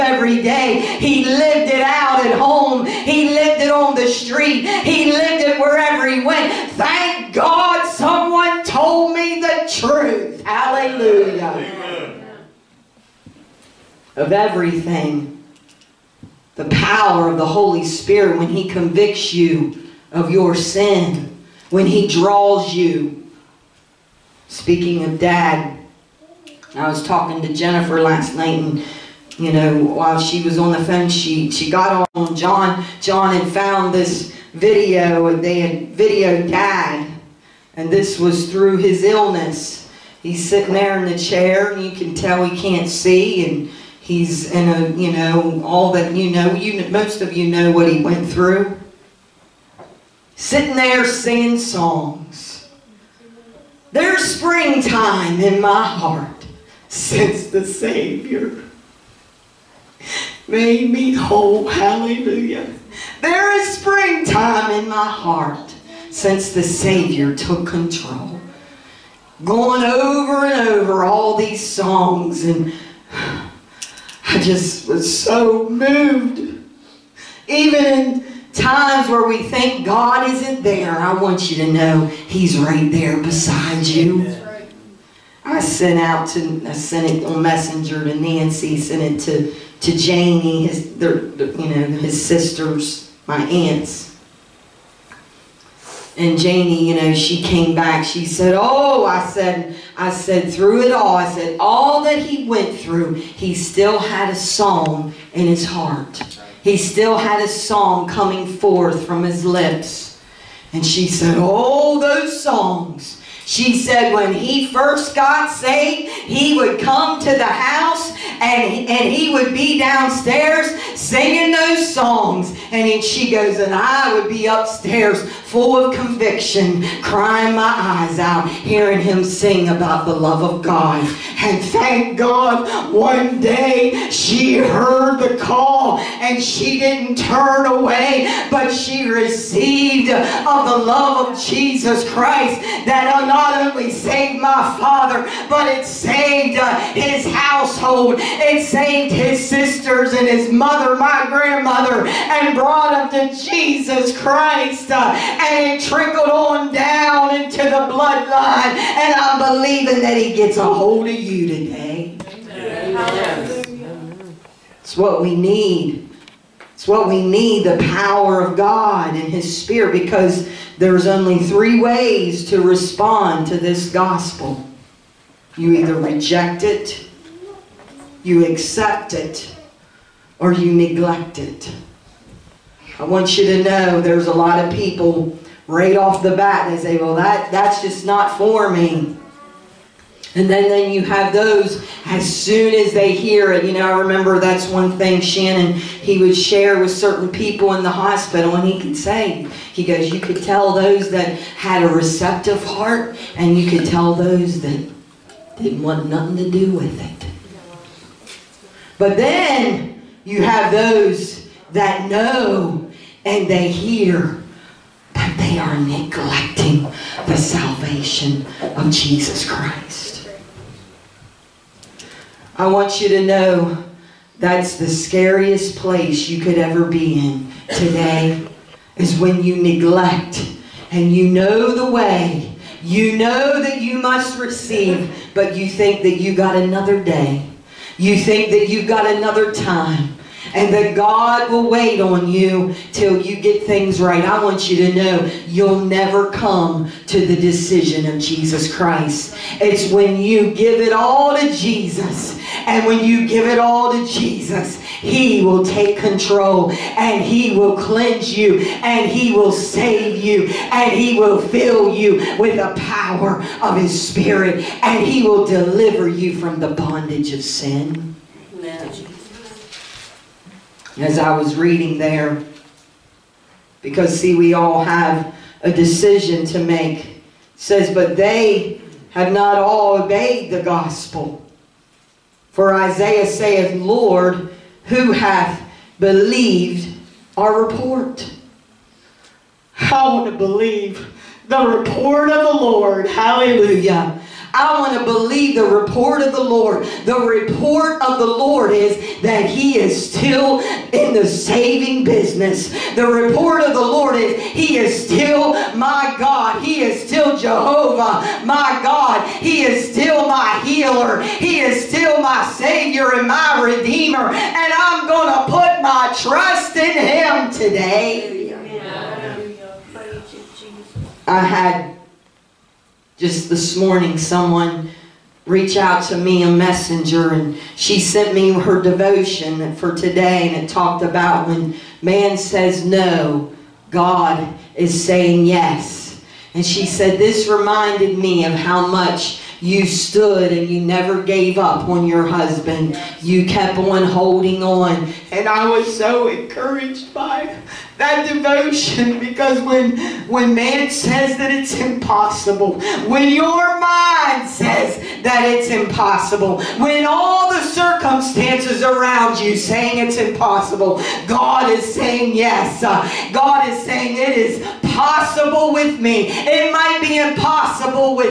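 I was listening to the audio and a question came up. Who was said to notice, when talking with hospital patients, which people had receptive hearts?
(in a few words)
Shannon.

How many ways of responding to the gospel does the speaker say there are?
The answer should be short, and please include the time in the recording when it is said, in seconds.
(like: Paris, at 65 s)
3, at 171 s.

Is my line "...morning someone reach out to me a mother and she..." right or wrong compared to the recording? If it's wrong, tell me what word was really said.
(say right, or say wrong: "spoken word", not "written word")
wrong: "messenger", not "mother".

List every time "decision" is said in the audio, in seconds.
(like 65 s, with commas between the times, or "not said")
247 s, 275 s.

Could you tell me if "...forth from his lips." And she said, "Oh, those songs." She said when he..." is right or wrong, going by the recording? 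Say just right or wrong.
right.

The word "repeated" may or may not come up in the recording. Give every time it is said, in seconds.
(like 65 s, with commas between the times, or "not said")
not said.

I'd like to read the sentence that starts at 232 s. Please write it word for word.
You know that you must receive, but you think that you got another day.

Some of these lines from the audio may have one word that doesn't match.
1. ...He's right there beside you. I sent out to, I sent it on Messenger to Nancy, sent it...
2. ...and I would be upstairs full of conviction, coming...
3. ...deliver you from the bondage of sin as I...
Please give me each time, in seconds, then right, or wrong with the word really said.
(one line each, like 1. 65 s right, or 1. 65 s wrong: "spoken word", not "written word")
1. 82 s right
2. 123 s wrong: "crying", not "coming"
3. 265 s right.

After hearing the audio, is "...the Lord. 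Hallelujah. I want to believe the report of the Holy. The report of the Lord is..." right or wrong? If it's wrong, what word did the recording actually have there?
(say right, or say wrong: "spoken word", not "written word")
wrong: "Lord", not "Holy".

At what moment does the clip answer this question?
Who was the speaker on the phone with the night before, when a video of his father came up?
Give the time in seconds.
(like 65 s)
27 s.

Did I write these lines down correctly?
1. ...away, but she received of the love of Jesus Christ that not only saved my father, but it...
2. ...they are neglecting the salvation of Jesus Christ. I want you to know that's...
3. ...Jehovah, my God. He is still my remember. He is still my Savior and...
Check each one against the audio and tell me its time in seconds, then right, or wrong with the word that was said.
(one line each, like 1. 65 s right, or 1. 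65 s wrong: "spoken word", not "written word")
1. 137 s right
2. 215 s right
3. 307 s wrong: "healer", not "remember".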